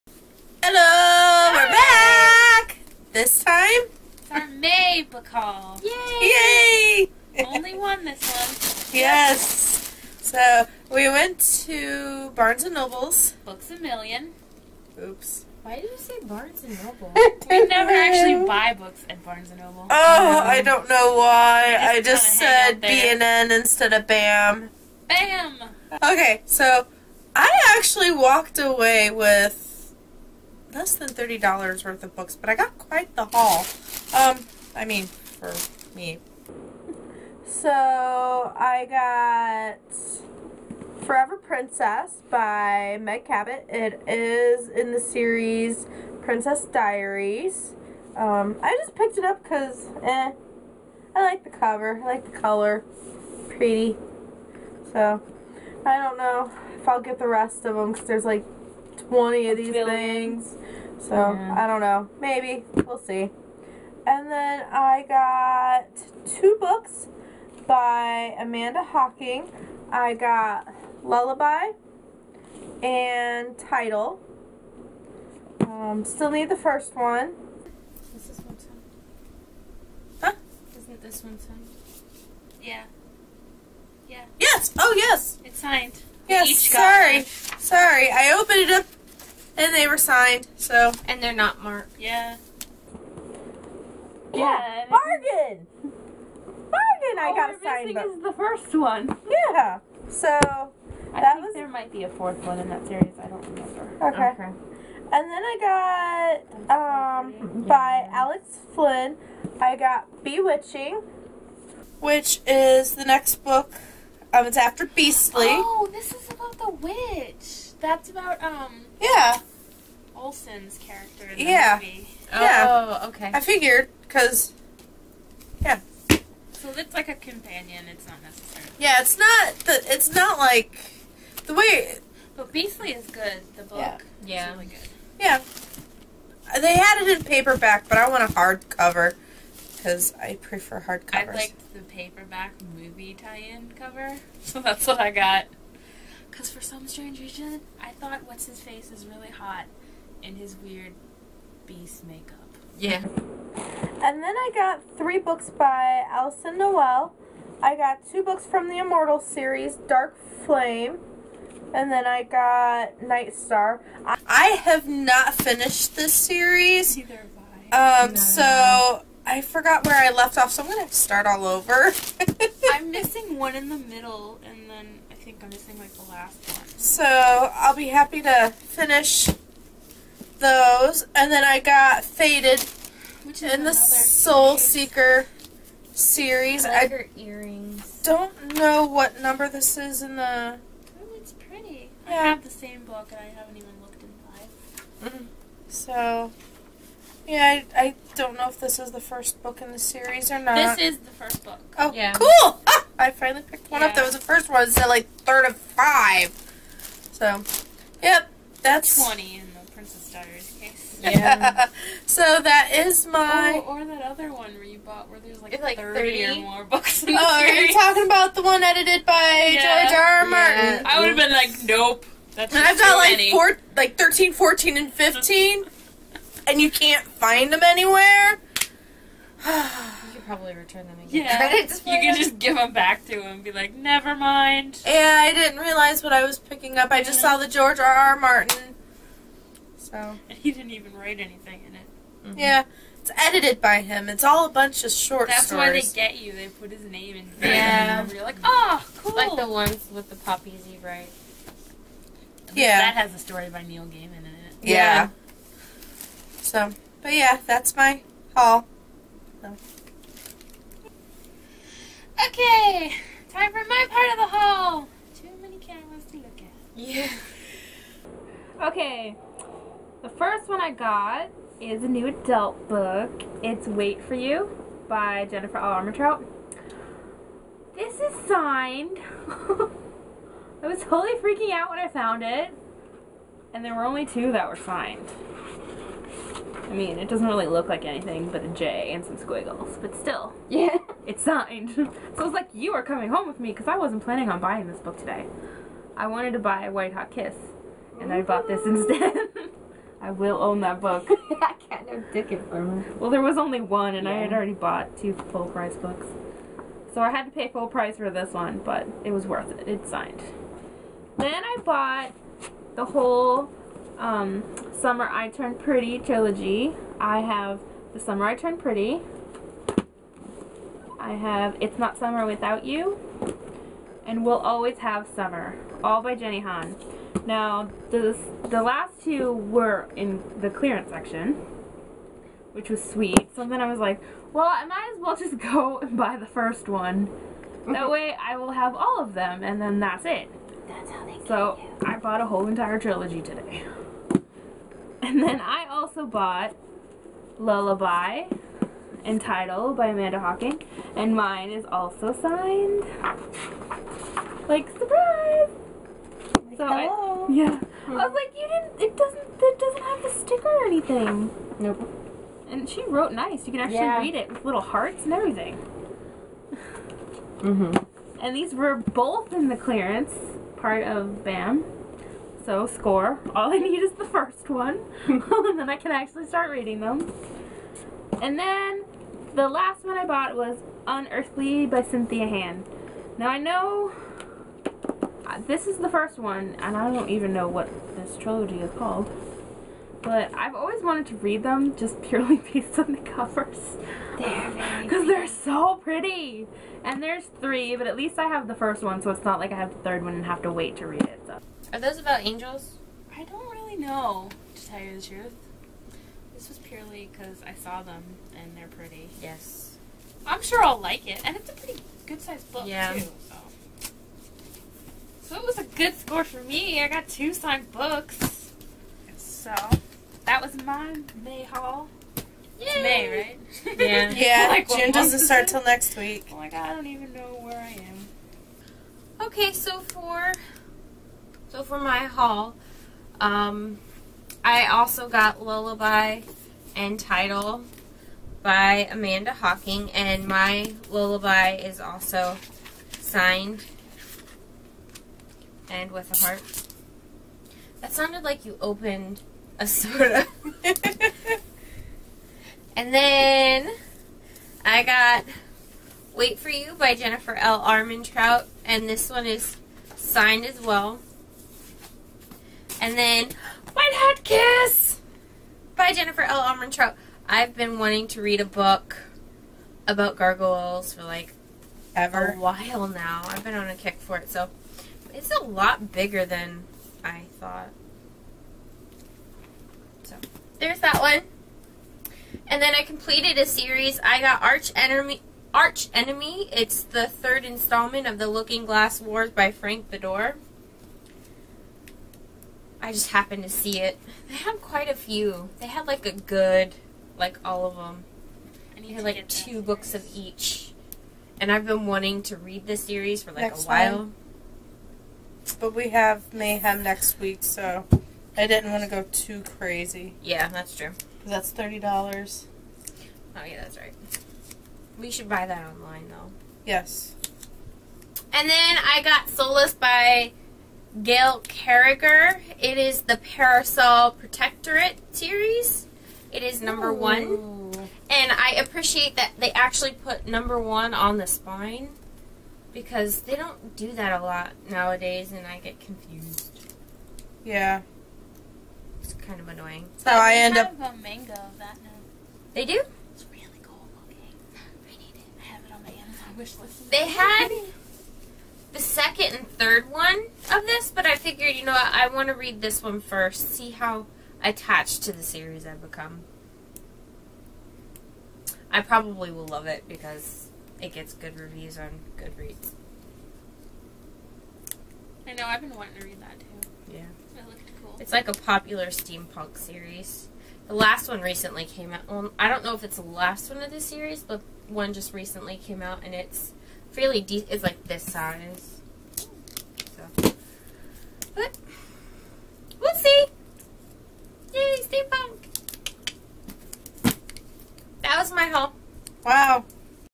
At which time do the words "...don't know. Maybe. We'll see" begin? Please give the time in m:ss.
1:01.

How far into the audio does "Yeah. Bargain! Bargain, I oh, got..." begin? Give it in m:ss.
1:34.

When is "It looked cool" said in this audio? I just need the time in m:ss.
9:27.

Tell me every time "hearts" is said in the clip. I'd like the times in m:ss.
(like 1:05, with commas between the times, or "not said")
6:04, 7:26.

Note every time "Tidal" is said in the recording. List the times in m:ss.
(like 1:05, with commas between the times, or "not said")
1:13, 5:49, 7:16.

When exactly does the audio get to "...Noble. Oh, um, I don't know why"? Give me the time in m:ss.
0:19.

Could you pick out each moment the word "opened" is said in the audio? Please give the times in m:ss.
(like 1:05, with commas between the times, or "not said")
1:28, 7:28.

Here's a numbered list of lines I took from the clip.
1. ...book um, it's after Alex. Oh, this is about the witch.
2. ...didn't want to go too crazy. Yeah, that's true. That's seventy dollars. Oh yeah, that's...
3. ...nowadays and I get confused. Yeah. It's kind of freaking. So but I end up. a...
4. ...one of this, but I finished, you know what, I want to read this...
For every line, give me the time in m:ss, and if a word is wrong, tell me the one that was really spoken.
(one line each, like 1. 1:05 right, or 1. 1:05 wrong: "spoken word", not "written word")
1. 1:53 wrong: "Beastly", not "Alex"
2. 8:28 wrong: "thirty", not "seventy"
3. 8:54 wrong: "annoying", not "freaking"
4. 9:09 wrong: "figured", not "finished".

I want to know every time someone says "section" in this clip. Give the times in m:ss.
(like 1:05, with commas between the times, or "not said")
5:30.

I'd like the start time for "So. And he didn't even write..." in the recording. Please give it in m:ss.
3:59.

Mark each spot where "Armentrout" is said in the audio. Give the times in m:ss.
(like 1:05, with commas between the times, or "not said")
4:35, 7:37, 7:46.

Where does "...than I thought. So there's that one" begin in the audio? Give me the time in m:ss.
7:56.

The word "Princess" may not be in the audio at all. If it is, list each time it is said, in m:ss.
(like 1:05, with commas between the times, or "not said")
0:41, 0:46, 3:29.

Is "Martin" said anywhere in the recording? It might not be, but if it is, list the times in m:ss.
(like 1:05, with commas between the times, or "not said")
3:40, 3:58.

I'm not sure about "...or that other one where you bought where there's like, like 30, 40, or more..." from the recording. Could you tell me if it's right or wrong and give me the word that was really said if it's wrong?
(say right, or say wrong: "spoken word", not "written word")
wrong: "30", not "40".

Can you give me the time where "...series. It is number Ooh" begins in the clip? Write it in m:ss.
8:45.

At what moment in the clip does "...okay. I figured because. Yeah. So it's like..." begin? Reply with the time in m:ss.
2:03.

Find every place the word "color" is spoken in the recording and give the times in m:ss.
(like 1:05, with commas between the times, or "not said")
0:52.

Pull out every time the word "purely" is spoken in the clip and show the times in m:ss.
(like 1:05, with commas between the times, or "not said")
6:32, 6:46.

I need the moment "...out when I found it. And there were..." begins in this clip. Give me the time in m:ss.
4:41.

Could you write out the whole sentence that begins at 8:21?
And I've been wanting to read this series for like next a while.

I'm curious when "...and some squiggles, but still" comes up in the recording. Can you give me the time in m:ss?
4:48.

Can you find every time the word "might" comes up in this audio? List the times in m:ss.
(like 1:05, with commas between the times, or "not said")
1:41, 5:34.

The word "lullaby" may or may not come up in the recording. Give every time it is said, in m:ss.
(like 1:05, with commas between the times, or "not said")
1:11, 5:47, 7:15, 7:20.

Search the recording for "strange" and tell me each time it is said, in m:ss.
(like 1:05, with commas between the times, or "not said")
2:26.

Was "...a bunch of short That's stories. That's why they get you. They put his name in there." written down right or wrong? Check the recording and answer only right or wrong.
right.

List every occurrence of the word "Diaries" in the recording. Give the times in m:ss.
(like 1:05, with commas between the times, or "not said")
0:46, 3:30.